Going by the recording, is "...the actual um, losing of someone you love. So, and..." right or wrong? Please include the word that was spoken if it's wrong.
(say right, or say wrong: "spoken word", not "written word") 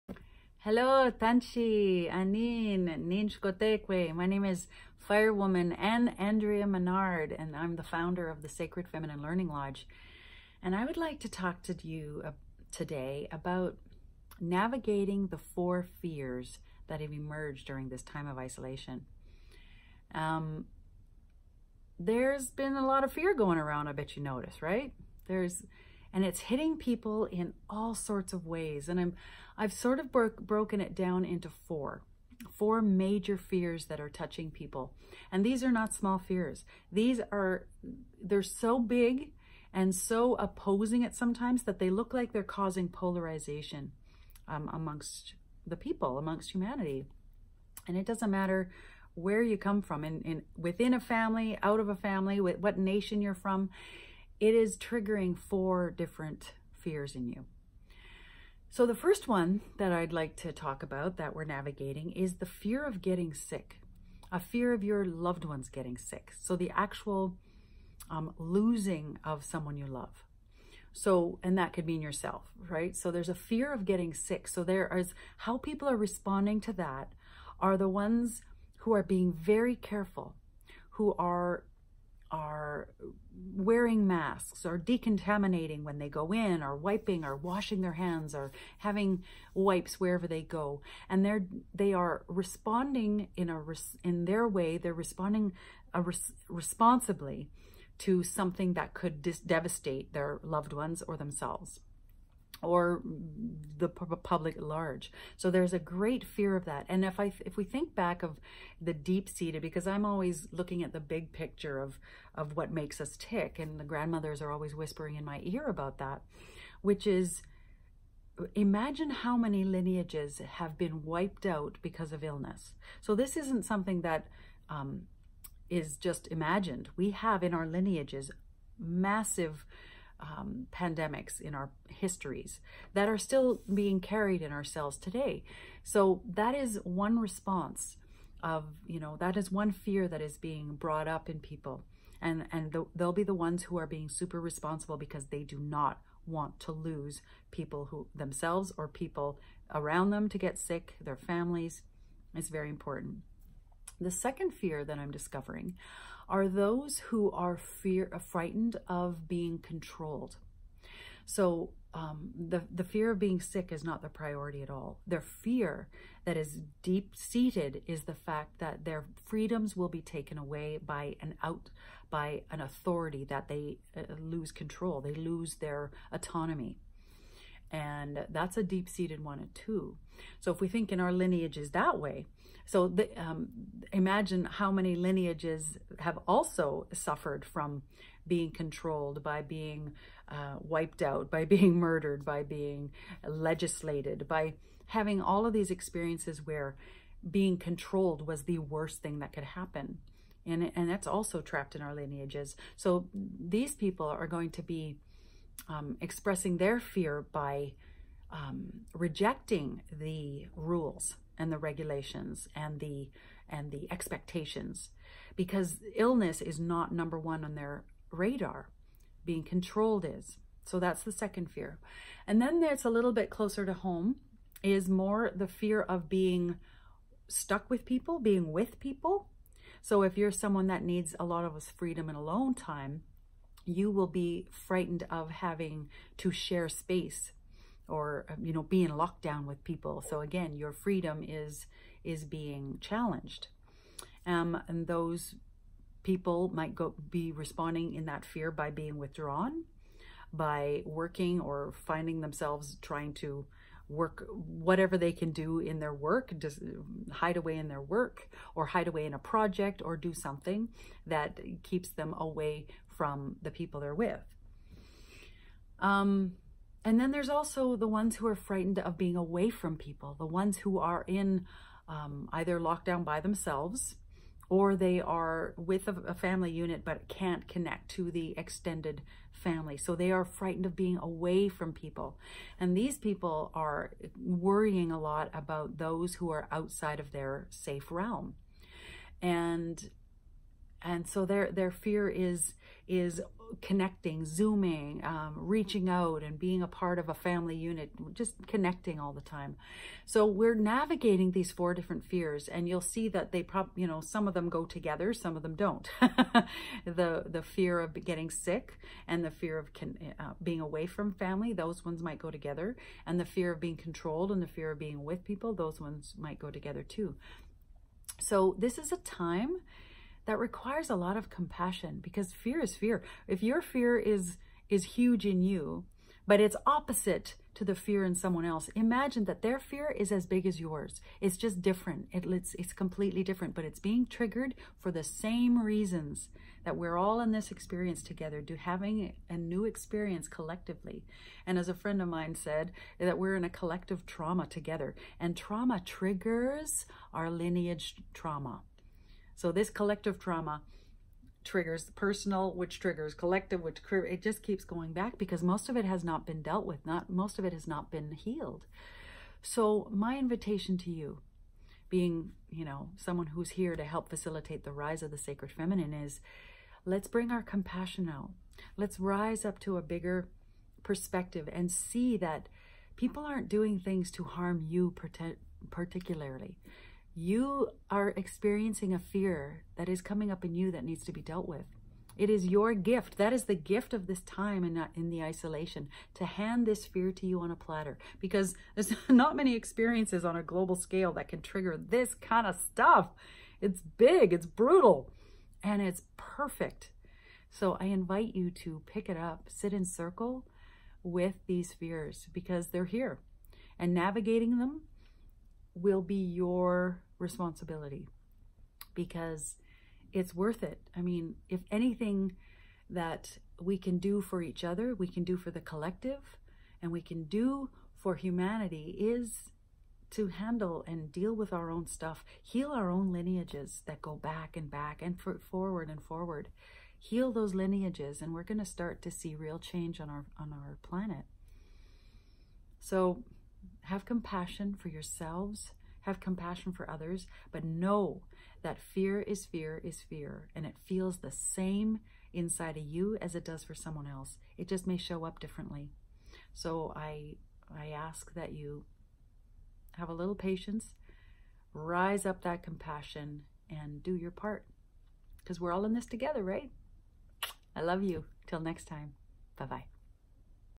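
right.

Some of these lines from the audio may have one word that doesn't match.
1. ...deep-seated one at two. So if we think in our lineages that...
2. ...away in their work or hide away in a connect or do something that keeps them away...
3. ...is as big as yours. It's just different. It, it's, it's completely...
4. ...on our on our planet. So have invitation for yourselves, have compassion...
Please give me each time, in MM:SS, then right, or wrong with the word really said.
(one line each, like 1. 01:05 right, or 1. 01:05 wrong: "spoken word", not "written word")
1. 02:58 right
2. 04:17 wrong: "project", not "connect"
3. 05:29 right
4. 07:10 wrong: "compassion", not "invitation".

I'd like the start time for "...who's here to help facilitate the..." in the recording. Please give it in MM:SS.
06:03.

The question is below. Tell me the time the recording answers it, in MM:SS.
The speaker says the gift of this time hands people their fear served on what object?
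06:27.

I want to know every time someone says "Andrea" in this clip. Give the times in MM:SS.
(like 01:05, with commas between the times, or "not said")
00:06.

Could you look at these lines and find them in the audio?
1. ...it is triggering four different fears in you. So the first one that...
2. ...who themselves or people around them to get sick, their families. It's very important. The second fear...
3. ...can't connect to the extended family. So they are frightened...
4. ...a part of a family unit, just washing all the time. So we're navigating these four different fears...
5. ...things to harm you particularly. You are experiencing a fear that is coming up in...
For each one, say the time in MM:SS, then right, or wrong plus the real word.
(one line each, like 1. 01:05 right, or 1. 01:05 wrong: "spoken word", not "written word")
1. 00:54 right
2. 02:27 right
3. 04:37 right
4. 04:56 wrong: "connecting", not "washing"
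5. 06:13 right.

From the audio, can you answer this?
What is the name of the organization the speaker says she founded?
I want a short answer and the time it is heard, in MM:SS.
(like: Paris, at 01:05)
Sacred Feminine Learning Lodge, at 00:08.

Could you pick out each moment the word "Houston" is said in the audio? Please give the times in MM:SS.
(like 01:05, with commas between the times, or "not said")
not said.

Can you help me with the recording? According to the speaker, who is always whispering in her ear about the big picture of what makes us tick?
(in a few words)
the grandmothers.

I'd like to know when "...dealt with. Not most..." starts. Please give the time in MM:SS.
05:56.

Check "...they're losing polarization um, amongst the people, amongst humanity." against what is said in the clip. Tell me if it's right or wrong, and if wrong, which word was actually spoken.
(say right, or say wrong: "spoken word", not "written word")
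wrong: "causing", not "losing".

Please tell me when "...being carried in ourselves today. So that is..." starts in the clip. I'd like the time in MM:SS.
02:13.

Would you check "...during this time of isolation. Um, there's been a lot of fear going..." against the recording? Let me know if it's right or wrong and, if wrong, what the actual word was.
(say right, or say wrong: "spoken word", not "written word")
right.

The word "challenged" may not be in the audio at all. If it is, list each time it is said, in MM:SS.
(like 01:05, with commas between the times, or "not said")
04:02.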